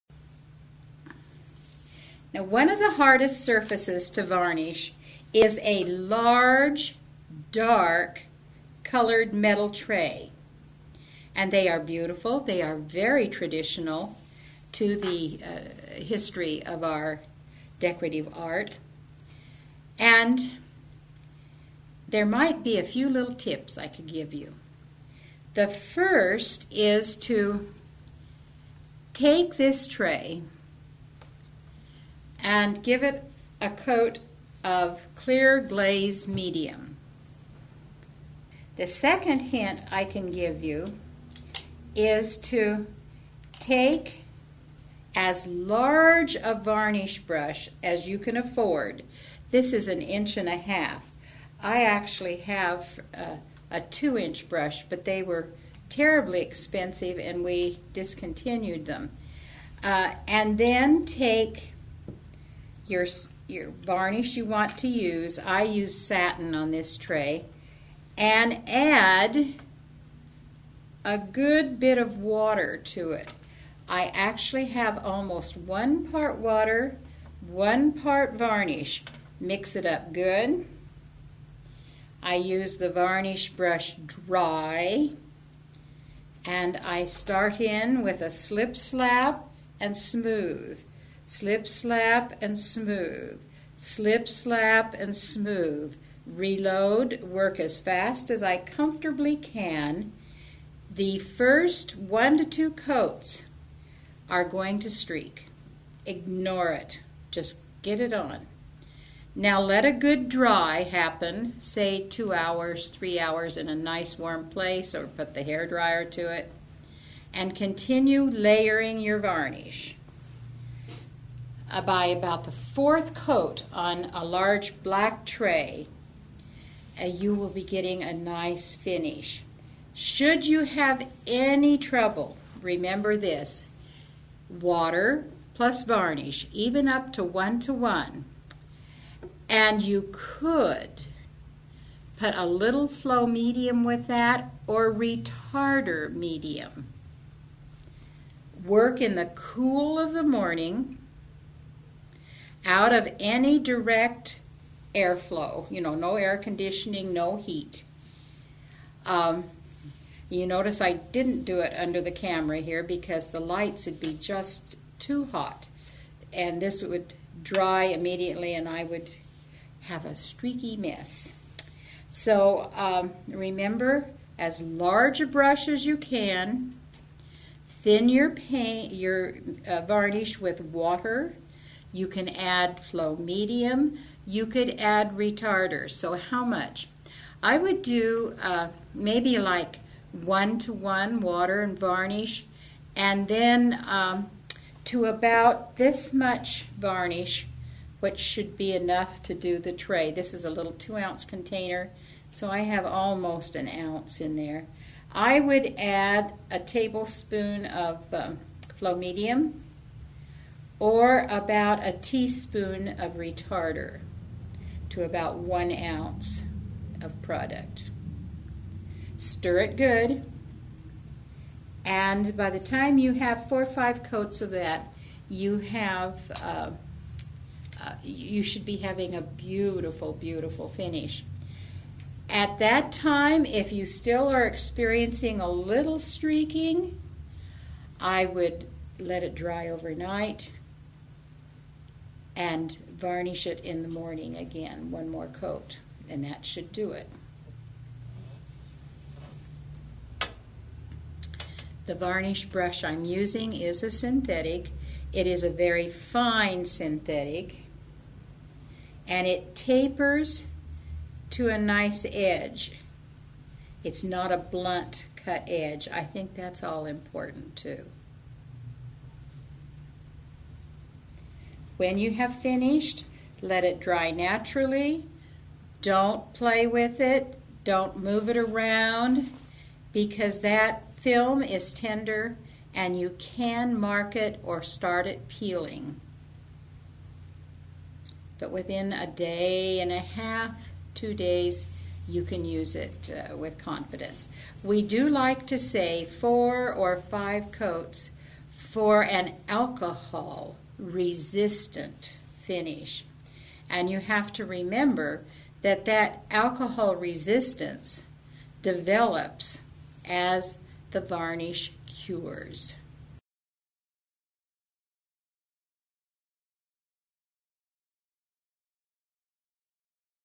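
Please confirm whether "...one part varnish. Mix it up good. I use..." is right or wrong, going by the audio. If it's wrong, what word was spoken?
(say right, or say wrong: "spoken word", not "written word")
right.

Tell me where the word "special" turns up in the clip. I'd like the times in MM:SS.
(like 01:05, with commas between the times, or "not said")
not said.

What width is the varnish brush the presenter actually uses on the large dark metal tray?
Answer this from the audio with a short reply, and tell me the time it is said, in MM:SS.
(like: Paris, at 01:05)
an inch and a half, at 00:49.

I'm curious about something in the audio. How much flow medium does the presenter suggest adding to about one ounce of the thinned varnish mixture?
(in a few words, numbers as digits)
a tablespoon.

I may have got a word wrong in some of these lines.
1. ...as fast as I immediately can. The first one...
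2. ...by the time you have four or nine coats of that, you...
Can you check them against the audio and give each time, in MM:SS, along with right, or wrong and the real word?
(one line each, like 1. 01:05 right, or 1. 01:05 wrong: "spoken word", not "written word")
1. 01:37 wrong: "comfortably", not "immediately"
2. 03:42 wrong: "five", not "nine".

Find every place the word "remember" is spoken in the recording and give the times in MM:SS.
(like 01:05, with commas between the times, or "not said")
02:12, 02:53, 05:04.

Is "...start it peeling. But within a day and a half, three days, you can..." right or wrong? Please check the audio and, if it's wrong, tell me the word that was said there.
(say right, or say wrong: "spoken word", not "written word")
wrong: "two", not "three".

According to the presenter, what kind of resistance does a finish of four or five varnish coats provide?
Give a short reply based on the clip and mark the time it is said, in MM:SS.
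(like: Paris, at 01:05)
alcohol resistant, at 04:59.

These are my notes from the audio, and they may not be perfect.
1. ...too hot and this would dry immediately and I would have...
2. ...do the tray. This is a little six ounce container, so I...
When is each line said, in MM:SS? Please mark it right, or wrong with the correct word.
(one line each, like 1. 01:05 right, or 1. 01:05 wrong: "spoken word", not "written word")
1. 02:44 right
2. 03:19 wrong: "two", not "six".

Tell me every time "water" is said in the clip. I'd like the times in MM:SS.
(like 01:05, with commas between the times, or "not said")
01:12, 01:16, 02:14, 03:00, 03:11.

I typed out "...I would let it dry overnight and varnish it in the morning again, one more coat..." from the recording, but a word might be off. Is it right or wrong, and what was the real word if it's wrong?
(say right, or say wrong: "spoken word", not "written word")
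right.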